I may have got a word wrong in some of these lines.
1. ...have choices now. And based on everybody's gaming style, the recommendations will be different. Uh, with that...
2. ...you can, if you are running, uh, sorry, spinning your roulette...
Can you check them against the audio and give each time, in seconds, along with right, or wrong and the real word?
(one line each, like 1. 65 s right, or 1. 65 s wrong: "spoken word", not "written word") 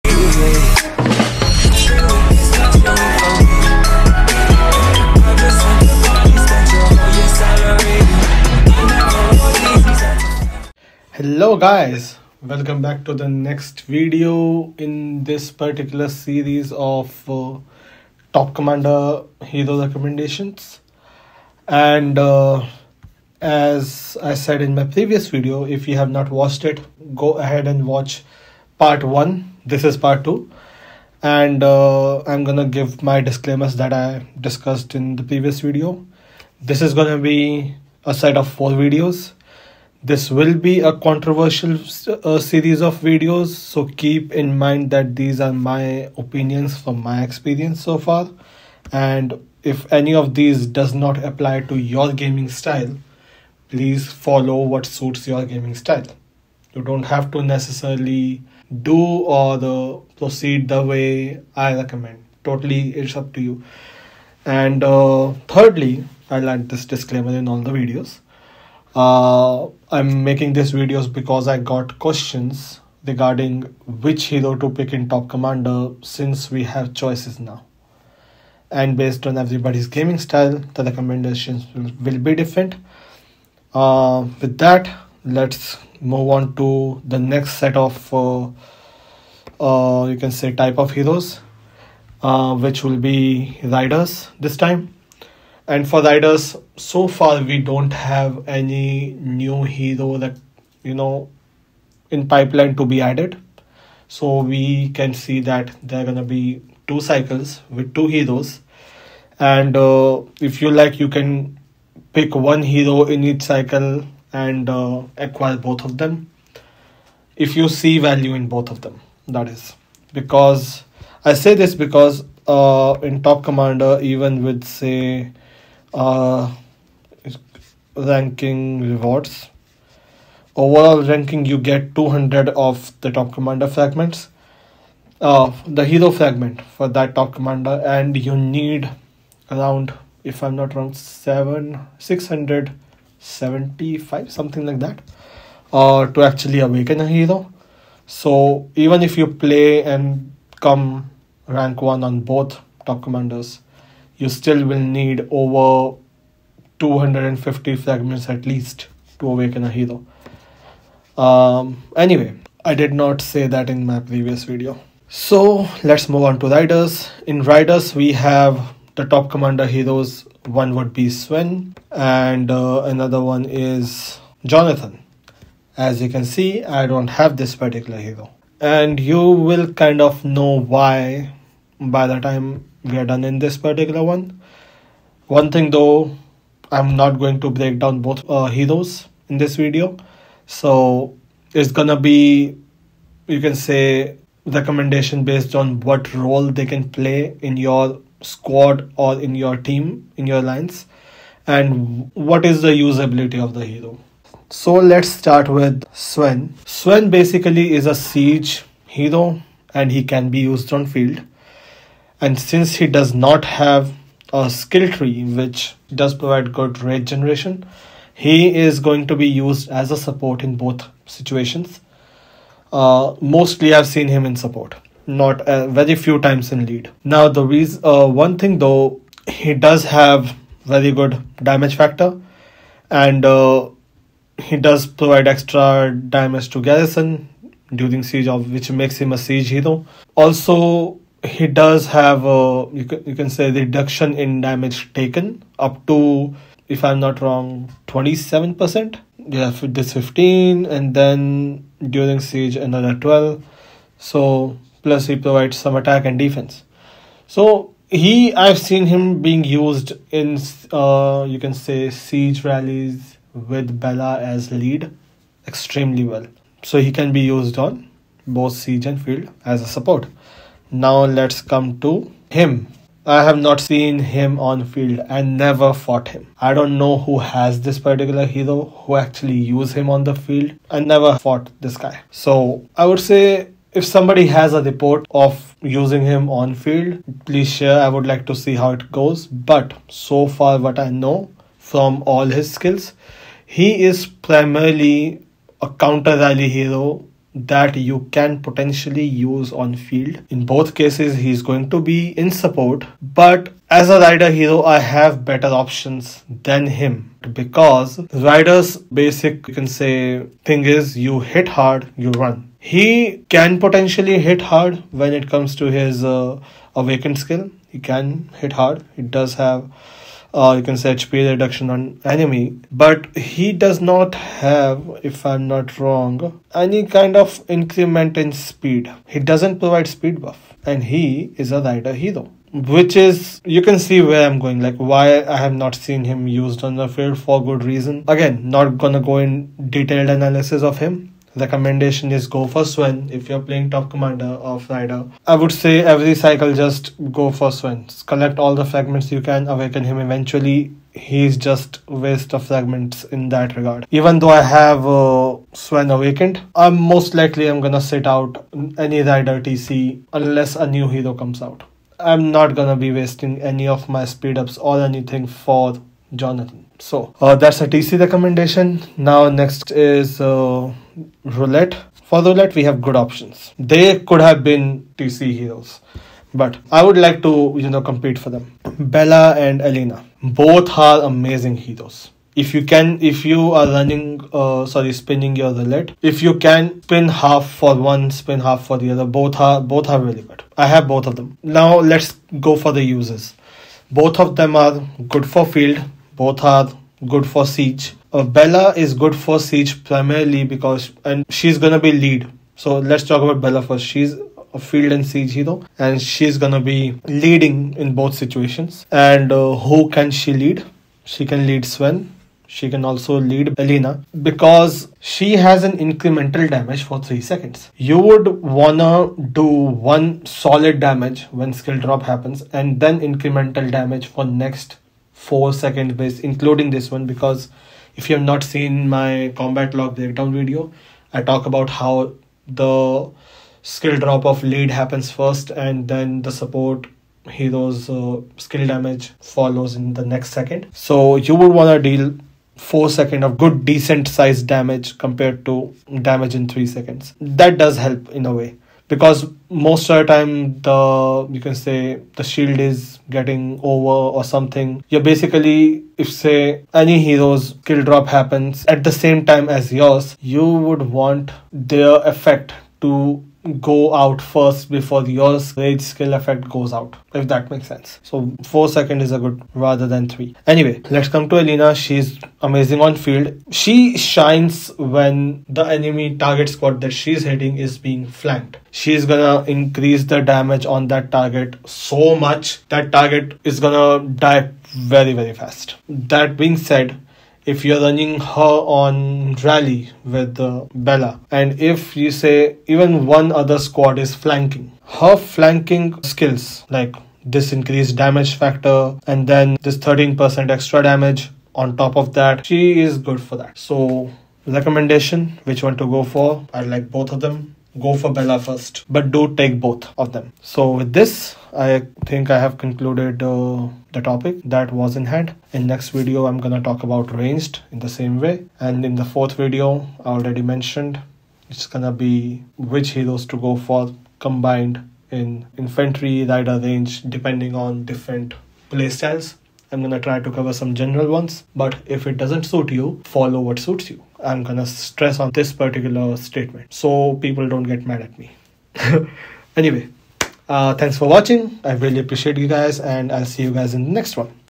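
1. 76 s right
2. 382 s right.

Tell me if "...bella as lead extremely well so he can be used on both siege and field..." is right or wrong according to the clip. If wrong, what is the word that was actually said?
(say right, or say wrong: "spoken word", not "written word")
right.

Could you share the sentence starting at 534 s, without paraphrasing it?
I'm gonna stress on this particular statement so people don't get mad at me.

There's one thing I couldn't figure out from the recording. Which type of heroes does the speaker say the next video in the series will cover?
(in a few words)
ranged.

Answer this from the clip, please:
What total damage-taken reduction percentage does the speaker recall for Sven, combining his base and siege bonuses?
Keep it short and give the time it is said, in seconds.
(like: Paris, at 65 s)
27%, at 247 s.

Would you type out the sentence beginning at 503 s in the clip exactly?
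So recommendation which one to go for i like both of them go for Bella first, but do take both of them.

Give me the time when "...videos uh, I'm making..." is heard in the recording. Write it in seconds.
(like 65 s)
67 s.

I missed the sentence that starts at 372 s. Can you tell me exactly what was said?
For roulette, we have good options.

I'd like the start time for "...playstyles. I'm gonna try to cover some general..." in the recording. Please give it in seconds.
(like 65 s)
528 s.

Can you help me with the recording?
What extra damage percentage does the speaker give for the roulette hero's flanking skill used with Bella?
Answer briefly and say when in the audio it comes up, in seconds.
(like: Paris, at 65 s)
13%, at 499 s.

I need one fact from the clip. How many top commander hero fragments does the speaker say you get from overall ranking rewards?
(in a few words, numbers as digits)
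200.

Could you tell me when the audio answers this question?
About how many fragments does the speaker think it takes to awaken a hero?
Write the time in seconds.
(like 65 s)
141 s.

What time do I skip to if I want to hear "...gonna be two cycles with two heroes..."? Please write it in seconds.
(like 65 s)
106 s.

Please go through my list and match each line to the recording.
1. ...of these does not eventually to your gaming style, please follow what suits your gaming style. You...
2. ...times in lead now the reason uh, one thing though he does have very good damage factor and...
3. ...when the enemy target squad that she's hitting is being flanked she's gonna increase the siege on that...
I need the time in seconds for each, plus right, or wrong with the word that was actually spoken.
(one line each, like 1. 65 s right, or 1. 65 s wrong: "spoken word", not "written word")
1. 50 s wrong: "apply", not "eventually"
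2. 226 s right
3. 474 s wrong: "damage", not "siege".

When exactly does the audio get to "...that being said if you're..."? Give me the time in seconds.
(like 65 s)
485 s.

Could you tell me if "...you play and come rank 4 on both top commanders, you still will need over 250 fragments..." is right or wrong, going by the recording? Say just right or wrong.
wrong.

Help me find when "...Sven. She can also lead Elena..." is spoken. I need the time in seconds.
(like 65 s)
411 s.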